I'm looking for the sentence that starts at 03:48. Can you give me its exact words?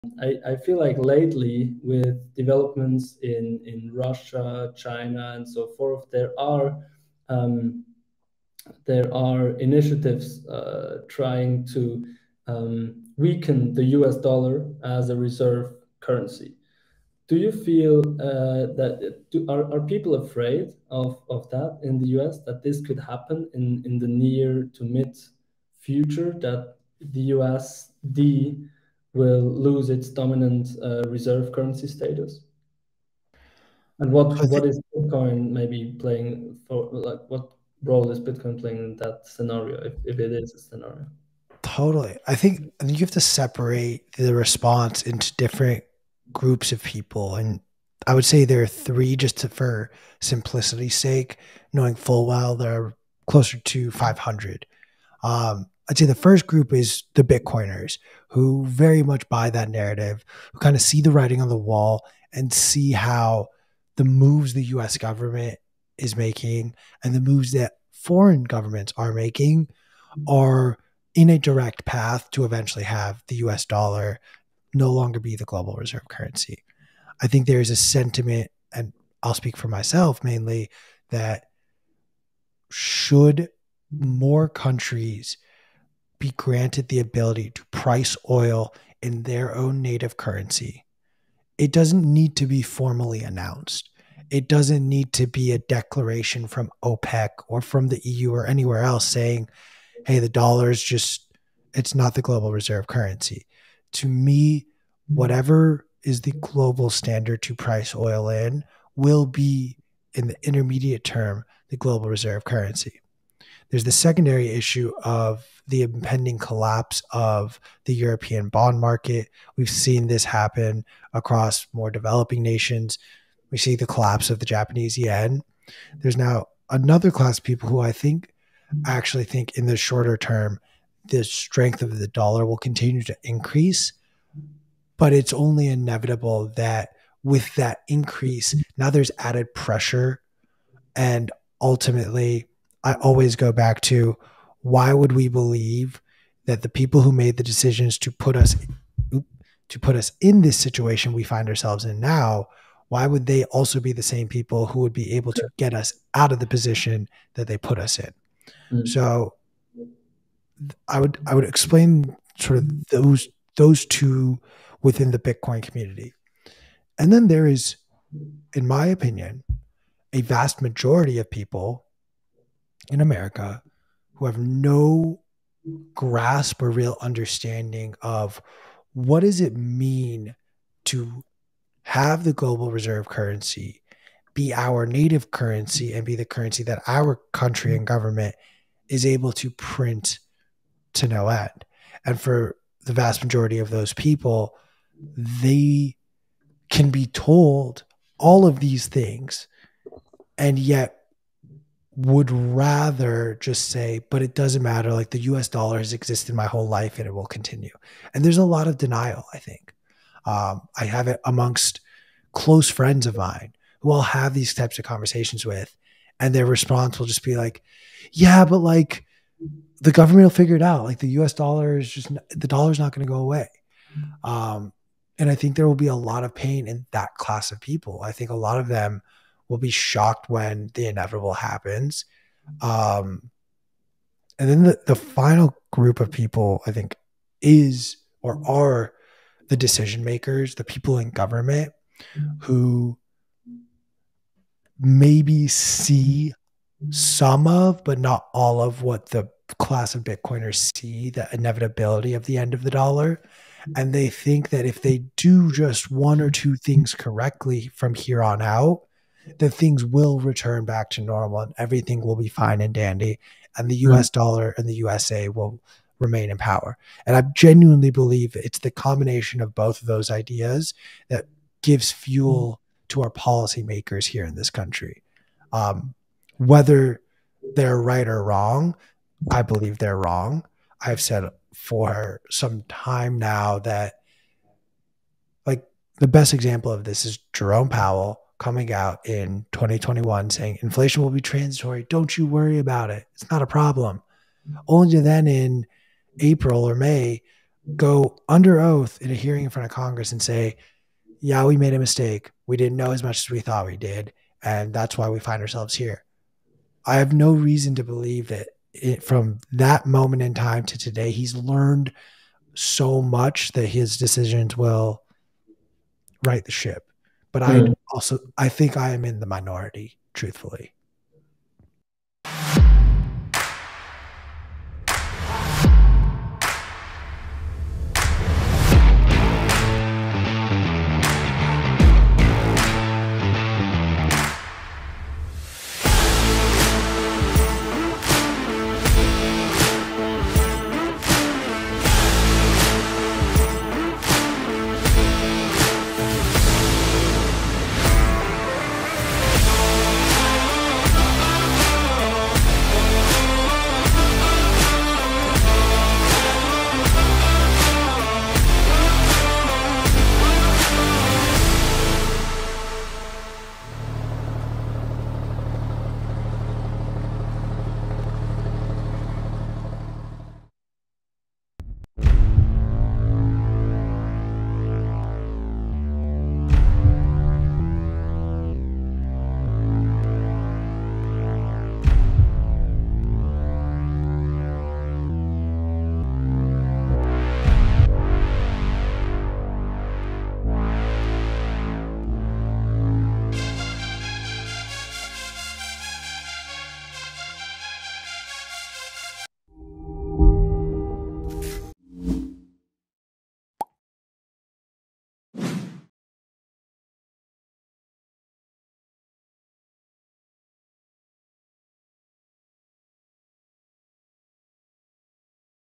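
I think a lot of them will be shocked when the inevitable happens.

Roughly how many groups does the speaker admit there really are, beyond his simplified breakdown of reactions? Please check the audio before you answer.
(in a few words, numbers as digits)
500.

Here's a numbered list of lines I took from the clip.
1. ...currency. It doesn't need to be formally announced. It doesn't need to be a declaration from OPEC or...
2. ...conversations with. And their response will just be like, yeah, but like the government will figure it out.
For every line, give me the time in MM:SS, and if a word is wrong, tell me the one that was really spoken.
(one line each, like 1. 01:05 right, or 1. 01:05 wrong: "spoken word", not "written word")
1. 01:30 right
2. 03:34 right.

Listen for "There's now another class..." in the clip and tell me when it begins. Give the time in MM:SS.
02:06.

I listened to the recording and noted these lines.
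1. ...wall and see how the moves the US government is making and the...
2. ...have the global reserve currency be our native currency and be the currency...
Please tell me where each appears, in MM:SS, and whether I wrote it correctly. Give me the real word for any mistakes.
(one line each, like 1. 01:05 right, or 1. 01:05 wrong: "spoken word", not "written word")
1. 01:01 right
2. 03:01 right.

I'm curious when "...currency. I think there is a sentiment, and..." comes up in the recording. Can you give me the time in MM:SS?
01:16.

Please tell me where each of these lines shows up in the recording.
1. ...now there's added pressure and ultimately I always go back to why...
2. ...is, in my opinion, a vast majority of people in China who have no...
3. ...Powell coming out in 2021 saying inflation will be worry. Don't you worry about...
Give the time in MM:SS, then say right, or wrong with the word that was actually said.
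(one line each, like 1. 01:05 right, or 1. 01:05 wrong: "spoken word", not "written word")
1. 02:18 right
2. 02:47 wrong: "America", not "China"
3. 04:47 wrong: "transitory", not "worry".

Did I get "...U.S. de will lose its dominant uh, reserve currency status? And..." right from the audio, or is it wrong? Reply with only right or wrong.
right.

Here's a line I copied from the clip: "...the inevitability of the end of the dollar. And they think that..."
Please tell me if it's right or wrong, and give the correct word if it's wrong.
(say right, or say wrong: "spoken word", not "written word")
right.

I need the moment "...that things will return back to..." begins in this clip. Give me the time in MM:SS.
04:19.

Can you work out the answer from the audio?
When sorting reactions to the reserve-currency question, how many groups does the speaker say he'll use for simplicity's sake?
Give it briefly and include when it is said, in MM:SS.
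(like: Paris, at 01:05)
3, at 00:48.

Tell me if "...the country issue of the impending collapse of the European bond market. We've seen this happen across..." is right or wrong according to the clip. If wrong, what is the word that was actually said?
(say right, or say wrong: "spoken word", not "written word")
wrong: "secondary", not "country".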